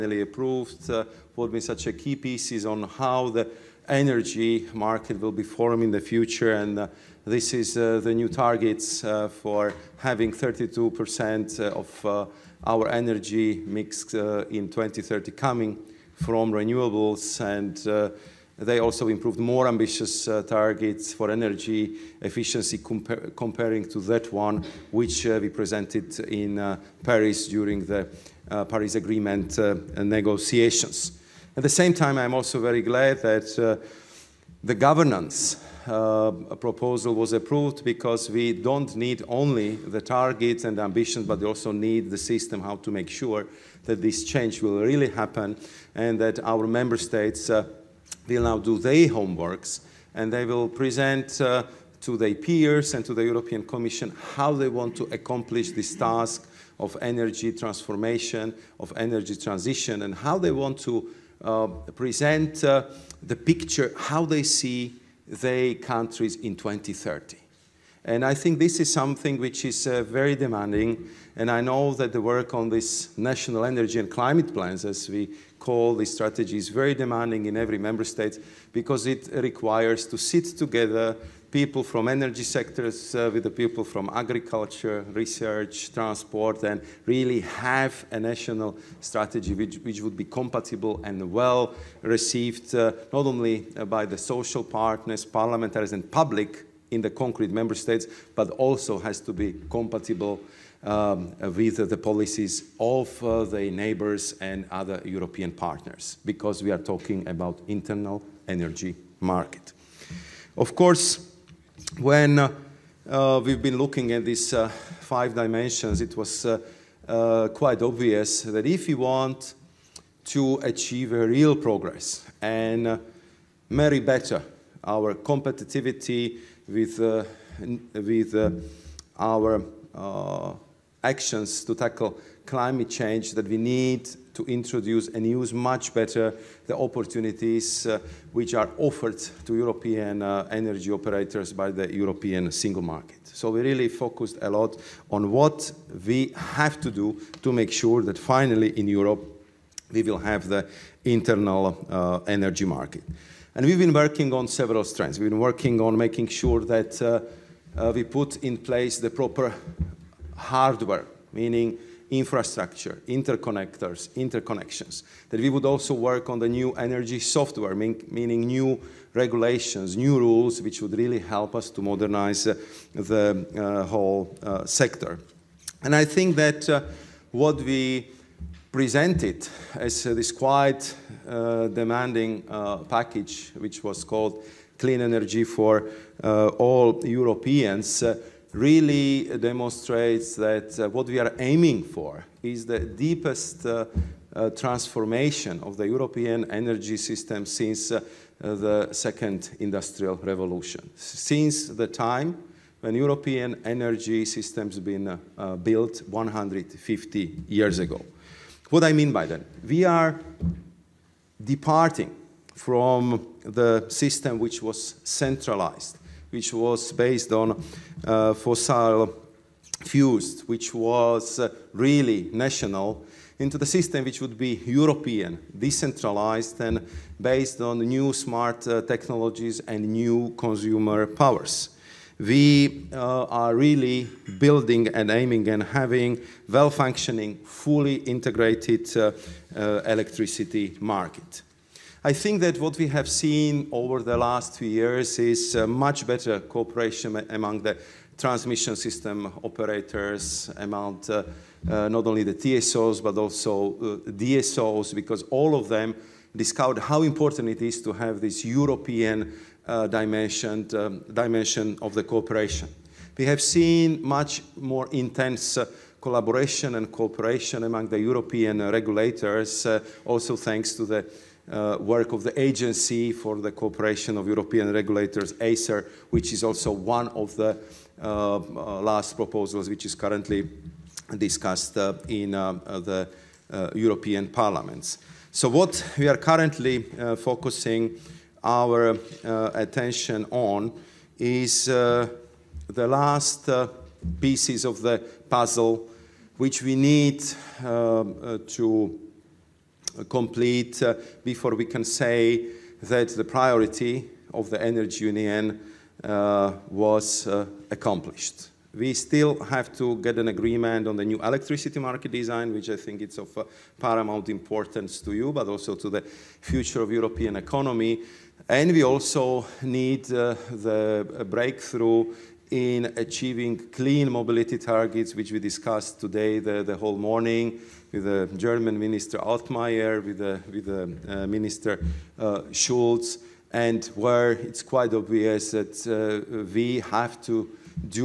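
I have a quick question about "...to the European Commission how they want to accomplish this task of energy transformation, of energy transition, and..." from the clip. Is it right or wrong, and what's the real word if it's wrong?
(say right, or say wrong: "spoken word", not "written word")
right.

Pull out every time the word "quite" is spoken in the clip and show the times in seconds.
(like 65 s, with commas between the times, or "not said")
117 s, 180 s, 334 s.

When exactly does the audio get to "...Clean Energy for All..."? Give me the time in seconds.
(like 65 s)
184 s.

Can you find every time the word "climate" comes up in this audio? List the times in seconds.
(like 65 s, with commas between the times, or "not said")
74 s, 132 s.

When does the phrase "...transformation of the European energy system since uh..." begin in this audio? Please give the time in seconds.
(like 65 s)
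194 s.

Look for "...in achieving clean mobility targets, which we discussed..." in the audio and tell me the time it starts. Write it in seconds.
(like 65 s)
322 s.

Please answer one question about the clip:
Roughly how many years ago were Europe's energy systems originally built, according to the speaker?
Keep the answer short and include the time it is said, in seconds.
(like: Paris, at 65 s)
150 years, at 206 s.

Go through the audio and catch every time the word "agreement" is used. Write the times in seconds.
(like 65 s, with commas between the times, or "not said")
28 s, 310 s.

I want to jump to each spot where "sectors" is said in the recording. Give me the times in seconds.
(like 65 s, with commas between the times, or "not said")
82 s, 174 s.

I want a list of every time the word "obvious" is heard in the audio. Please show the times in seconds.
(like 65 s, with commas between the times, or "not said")
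117 s, 334 s.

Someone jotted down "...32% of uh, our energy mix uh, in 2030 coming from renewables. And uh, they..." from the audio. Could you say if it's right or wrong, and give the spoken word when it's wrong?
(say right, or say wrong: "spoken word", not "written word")
right.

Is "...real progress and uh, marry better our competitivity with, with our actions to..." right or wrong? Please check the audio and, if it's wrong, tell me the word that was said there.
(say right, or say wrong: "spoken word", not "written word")
right.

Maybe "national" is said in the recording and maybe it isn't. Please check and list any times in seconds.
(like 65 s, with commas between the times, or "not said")
73 s, 88 s, 222 s.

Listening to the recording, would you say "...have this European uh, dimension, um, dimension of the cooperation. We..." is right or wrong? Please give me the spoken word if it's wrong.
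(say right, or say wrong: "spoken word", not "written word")
right.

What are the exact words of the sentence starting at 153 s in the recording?
And we've been working on several strands.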